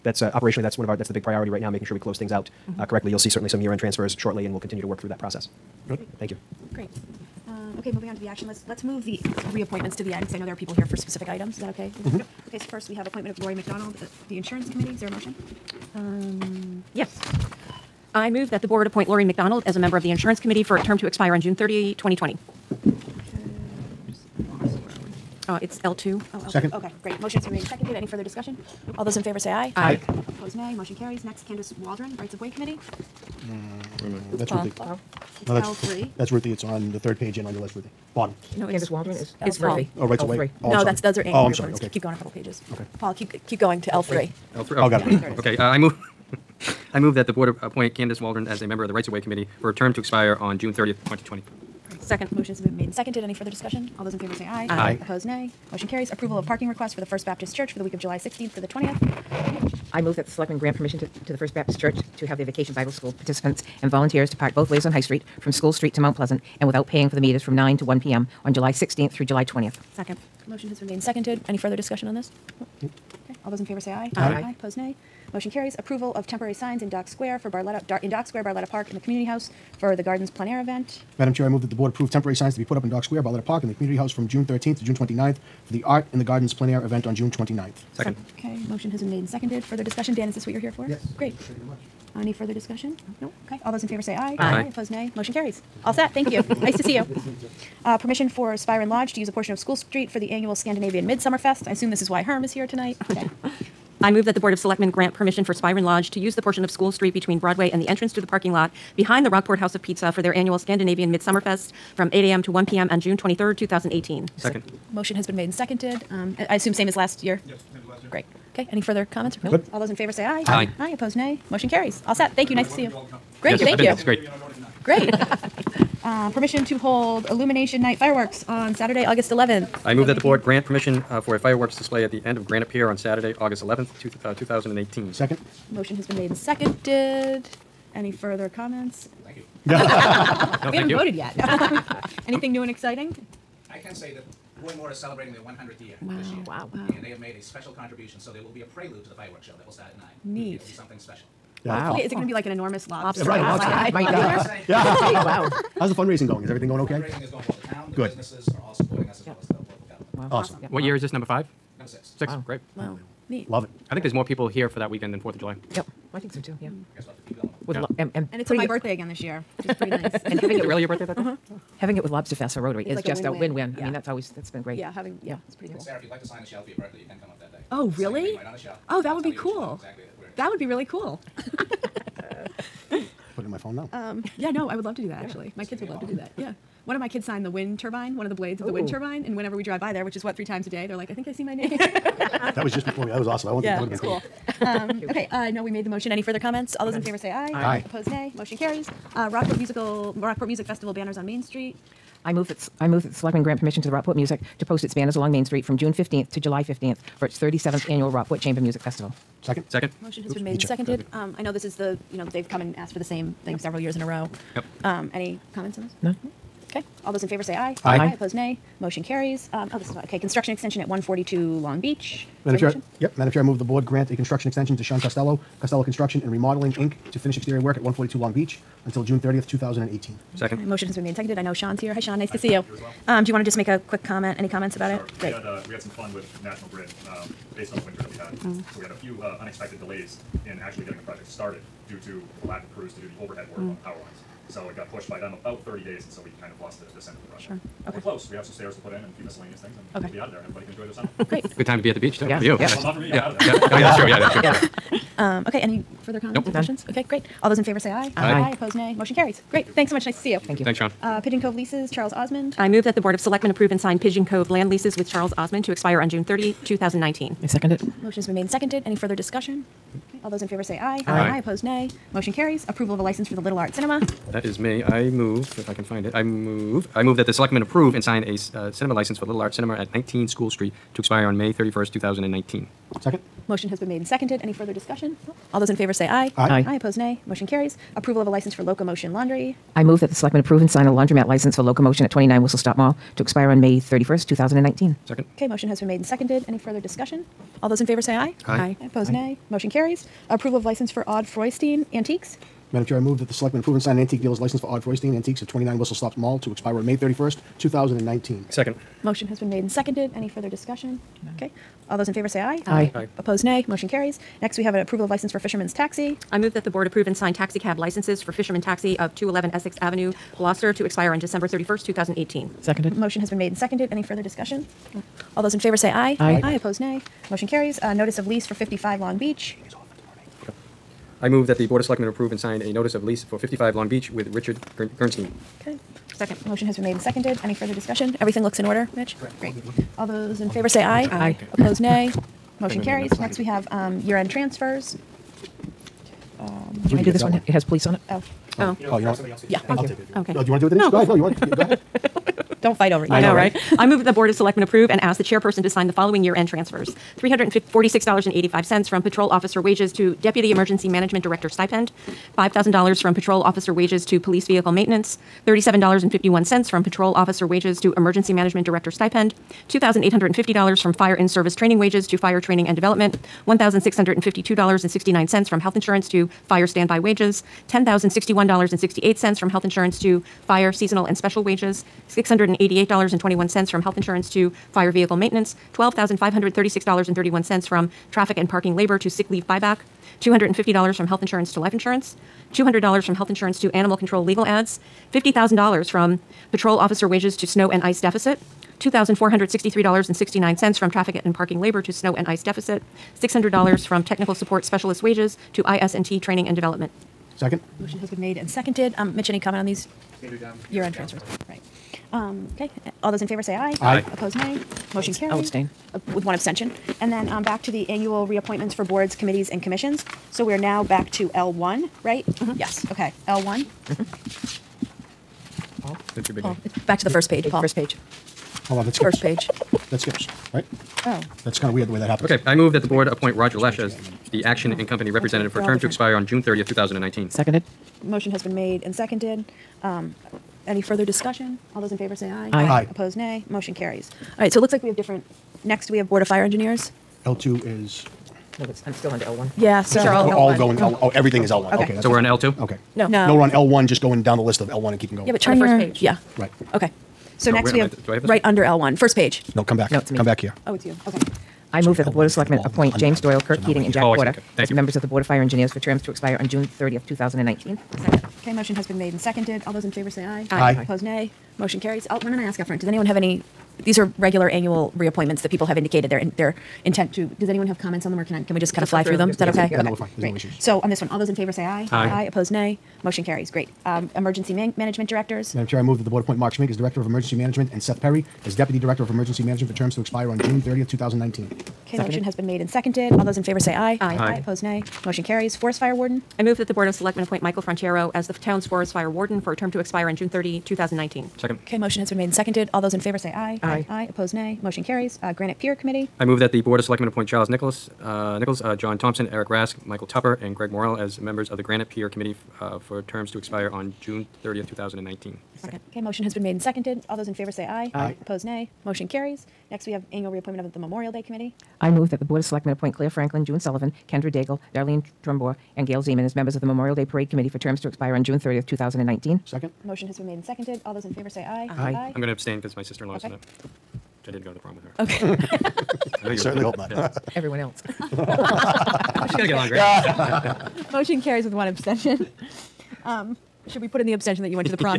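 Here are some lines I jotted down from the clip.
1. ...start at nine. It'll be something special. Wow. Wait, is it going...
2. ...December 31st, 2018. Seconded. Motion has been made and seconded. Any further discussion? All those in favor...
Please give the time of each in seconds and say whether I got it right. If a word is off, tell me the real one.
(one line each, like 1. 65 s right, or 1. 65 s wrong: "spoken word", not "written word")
1. 149 s right
2. 321 s right.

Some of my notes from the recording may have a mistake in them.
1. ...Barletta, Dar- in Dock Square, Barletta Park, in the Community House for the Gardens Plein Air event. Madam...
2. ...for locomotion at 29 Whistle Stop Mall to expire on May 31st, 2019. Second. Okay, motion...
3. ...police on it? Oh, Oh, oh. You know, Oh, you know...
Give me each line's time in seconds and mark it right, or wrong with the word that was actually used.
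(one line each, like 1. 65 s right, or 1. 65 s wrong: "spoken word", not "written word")
1. 77 s right
2. 291 s right
3. 347 s right.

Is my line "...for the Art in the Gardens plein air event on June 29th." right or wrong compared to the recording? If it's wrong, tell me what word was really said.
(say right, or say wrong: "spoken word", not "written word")
right.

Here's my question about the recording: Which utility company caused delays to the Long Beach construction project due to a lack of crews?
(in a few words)
National Grid.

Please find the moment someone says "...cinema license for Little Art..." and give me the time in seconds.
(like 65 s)
278 s.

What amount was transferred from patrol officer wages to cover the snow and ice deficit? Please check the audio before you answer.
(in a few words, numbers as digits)
$50,000.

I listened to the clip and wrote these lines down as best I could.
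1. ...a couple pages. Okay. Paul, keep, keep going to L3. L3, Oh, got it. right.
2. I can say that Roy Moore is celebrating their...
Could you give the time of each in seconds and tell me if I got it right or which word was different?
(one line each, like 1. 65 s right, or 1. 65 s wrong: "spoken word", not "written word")
1. 42 s right
2. 143 s right.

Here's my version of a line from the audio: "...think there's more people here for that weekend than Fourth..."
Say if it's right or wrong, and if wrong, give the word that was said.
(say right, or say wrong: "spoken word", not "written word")
right.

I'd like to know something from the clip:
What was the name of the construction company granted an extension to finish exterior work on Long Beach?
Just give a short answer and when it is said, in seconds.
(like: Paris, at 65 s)
Costello Construction and Remodeling, at 225 s.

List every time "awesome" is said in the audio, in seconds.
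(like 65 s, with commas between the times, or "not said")
160 s, 193 s.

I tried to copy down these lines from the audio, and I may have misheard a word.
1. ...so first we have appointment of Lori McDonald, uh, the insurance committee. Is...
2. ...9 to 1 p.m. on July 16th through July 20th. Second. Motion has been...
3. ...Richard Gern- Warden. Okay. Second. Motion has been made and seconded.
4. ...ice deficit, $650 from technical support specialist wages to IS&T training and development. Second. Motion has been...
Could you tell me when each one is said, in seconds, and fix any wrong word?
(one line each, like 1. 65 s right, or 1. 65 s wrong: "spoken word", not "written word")
1. 12 s right
2. 67 s right
3. 334 s wrong: "Gernstein", not "Warden"
4. 402 s wrong: "600", not "650".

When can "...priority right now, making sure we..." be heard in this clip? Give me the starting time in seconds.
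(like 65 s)
1 s.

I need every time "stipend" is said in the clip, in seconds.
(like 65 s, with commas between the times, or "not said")
361 s, 368 s.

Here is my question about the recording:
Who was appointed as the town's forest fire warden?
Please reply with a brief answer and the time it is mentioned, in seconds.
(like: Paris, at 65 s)
Michael Franchero, at 497 s.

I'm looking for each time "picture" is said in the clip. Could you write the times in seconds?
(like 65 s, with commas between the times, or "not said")
not said.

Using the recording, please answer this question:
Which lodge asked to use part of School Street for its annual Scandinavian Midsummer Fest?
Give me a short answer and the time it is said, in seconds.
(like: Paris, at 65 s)
Spyron Lodge, at 105 s.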